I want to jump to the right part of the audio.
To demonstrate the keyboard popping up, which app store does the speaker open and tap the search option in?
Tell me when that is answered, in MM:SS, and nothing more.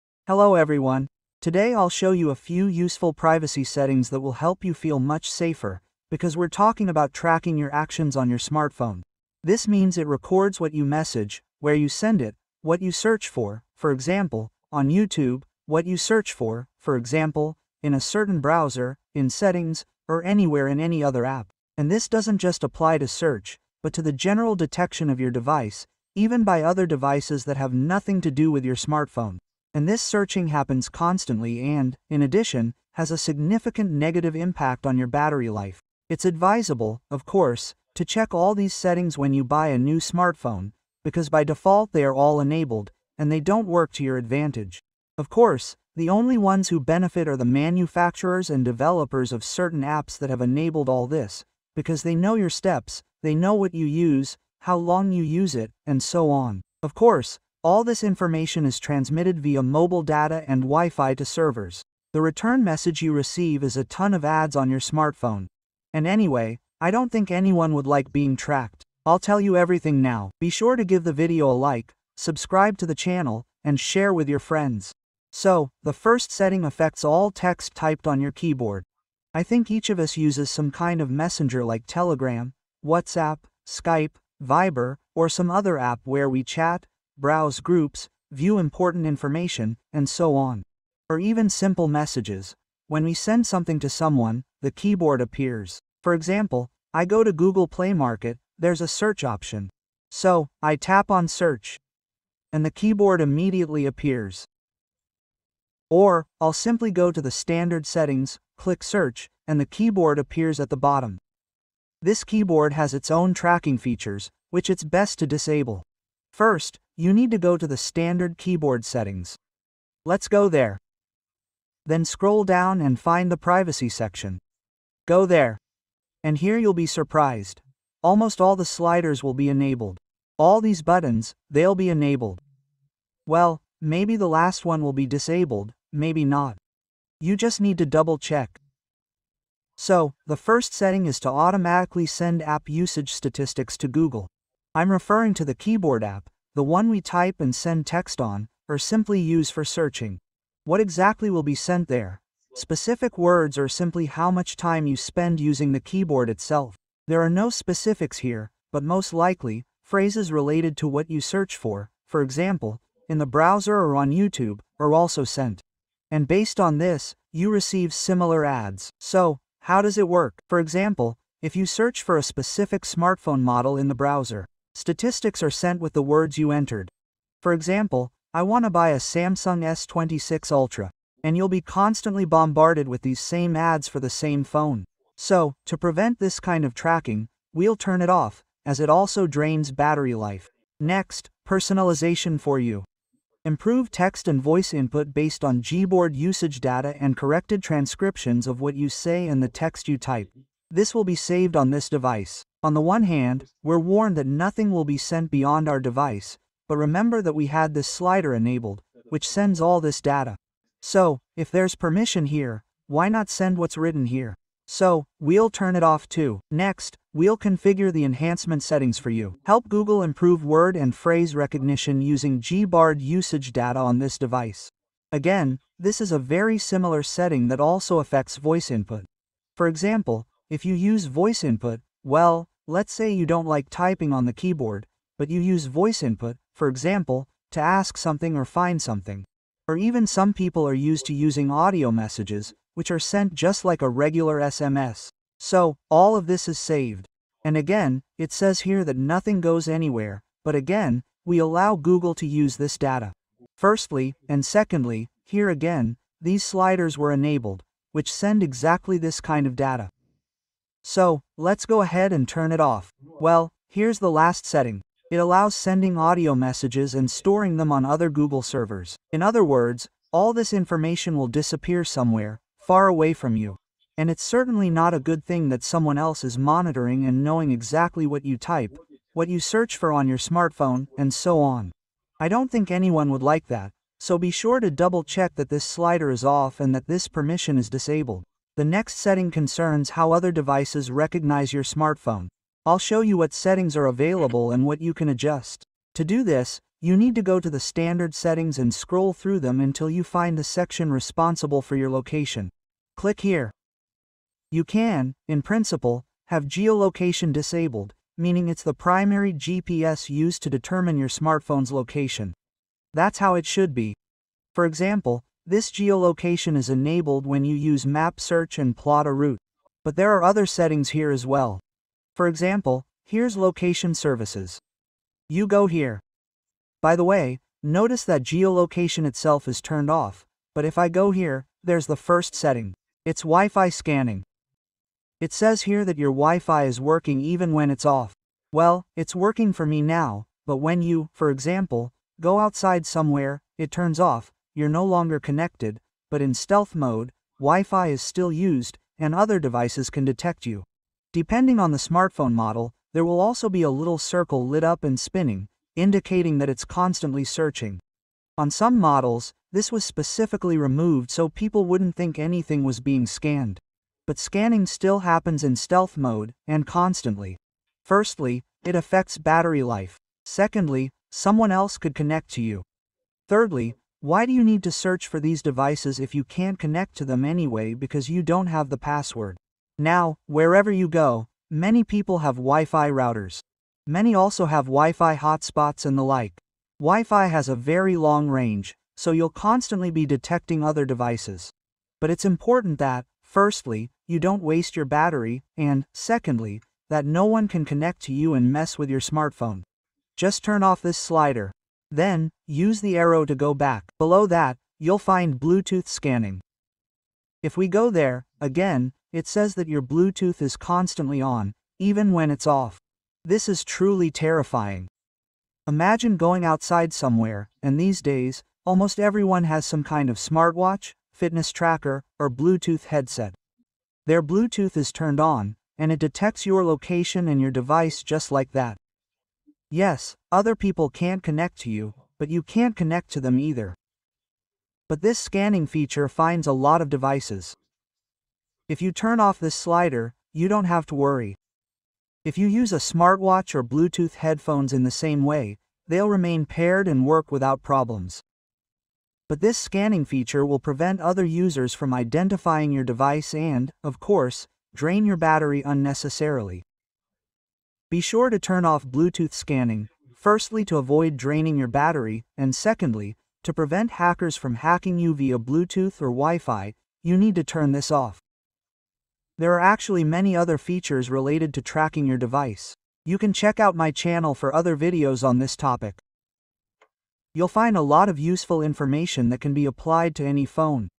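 01:37.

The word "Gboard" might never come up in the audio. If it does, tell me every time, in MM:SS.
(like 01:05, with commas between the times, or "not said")
03:15, 03:42.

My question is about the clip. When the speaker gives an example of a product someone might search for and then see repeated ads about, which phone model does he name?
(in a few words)
Samsung S26 Ultra.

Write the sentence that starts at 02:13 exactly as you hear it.
Well, maybe the last one will be disabled, maybe not.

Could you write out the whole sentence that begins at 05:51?
Depending on the smartphone model, there will also be a little circle lit up and spinning, indicating that it's constantly searching.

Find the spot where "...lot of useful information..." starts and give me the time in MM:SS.
07:57.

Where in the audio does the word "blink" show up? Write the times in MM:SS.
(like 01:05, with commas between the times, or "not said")
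not said.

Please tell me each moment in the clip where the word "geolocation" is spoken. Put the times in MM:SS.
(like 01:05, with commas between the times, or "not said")
05:06, 05:15, 05:28.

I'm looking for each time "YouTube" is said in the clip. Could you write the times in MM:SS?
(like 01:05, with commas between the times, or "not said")
00:14, 02:44.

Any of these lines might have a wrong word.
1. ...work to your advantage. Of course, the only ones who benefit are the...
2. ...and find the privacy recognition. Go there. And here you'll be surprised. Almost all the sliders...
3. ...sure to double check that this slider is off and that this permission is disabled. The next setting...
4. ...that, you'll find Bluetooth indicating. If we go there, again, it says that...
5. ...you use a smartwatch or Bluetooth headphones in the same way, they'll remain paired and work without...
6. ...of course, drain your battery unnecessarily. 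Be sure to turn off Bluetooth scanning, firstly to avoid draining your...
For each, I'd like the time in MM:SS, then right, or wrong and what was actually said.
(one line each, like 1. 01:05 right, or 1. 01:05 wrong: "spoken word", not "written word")
1. 00:43 right
2. 02:02 wrong: "section", not "recognition"
3. 04:44 right
4. 06:44 wrong: "scanning", not "indicating"
5. 07:22 right
6. 07:33 right.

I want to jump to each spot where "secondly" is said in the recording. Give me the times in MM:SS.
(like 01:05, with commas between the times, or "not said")
04:14, 06:10, 06:35, 07:42.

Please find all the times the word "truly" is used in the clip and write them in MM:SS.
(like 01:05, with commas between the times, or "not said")
06:53.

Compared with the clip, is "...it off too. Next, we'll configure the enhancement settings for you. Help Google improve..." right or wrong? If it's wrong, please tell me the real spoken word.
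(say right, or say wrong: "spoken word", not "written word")
right.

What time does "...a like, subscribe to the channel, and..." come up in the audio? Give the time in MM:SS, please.
01:11.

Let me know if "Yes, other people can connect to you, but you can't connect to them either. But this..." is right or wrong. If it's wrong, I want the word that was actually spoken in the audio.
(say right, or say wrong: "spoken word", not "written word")
right.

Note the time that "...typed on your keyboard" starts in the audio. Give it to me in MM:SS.
01:17.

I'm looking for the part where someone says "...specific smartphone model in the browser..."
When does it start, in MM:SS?
02:52.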